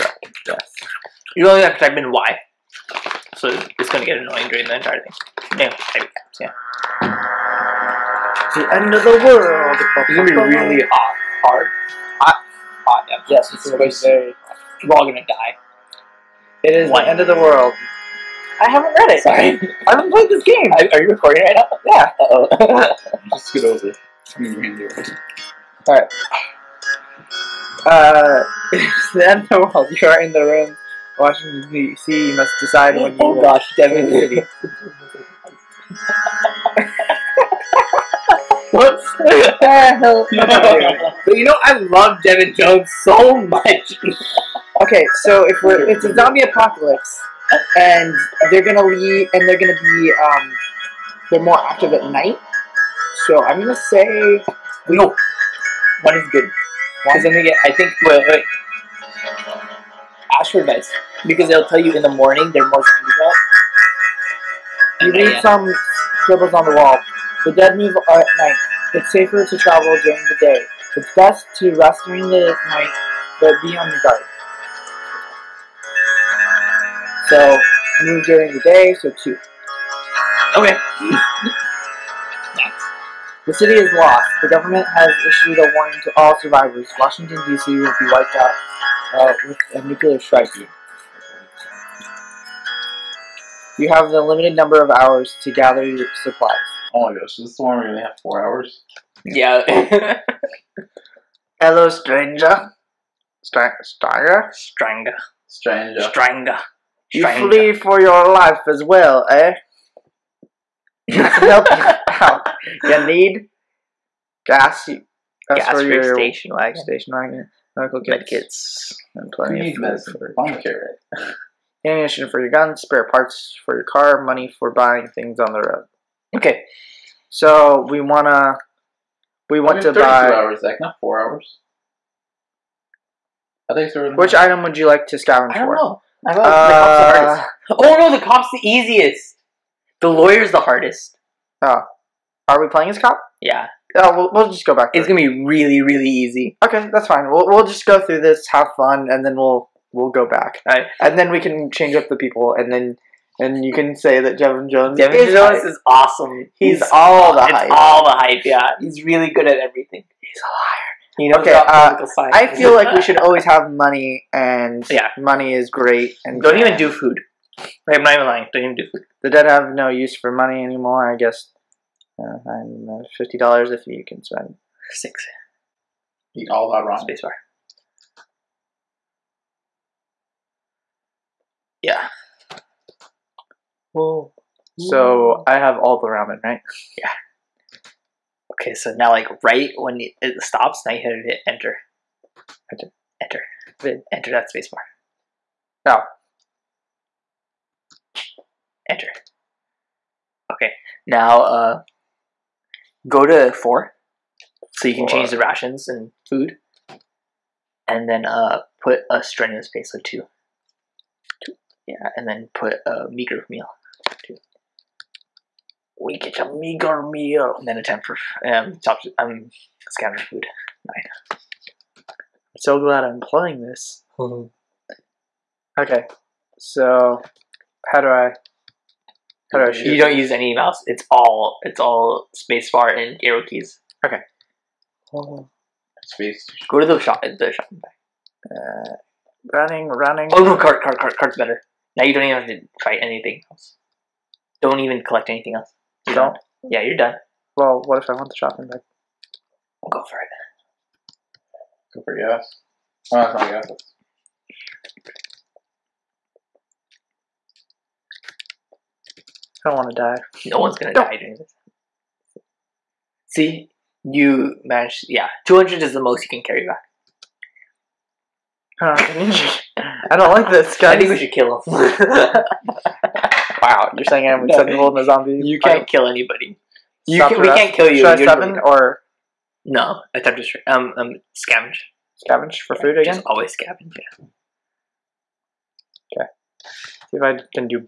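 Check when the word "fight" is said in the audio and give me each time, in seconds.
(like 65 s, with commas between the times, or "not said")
242 s, 275 s.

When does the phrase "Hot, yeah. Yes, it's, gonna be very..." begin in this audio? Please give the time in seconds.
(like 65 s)
12 s.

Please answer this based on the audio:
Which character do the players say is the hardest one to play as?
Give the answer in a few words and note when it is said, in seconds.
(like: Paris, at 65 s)
The lawyer, at 139 s.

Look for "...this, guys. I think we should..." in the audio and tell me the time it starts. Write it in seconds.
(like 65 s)
270 s.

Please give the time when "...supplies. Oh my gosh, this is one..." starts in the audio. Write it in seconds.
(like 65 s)
96 s.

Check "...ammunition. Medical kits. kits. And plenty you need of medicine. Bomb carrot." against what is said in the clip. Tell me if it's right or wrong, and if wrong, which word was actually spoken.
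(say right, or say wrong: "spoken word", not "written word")
wrong: "wagon", not "ammunition".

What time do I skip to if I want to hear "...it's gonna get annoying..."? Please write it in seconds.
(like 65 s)
3 s.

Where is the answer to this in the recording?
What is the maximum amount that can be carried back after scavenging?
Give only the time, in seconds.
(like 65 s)
265 s.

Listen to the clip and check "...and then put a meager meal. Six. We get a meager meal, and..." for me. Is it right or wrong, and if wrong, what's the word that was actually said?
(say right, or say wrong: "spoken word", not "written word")
wrong: "Two", not "Six".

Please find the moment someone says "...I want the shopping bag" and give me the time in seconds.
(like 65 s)
248 s.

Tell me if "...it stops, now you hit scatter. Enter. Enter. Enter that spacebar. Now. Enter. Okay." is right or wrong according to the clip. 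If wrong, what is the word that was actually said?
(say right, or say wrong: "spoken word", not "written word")
wrong: "enter", not "scatter".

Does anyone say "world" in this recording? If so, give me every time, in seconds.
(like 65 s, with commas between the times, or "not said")
9 s, 17 s.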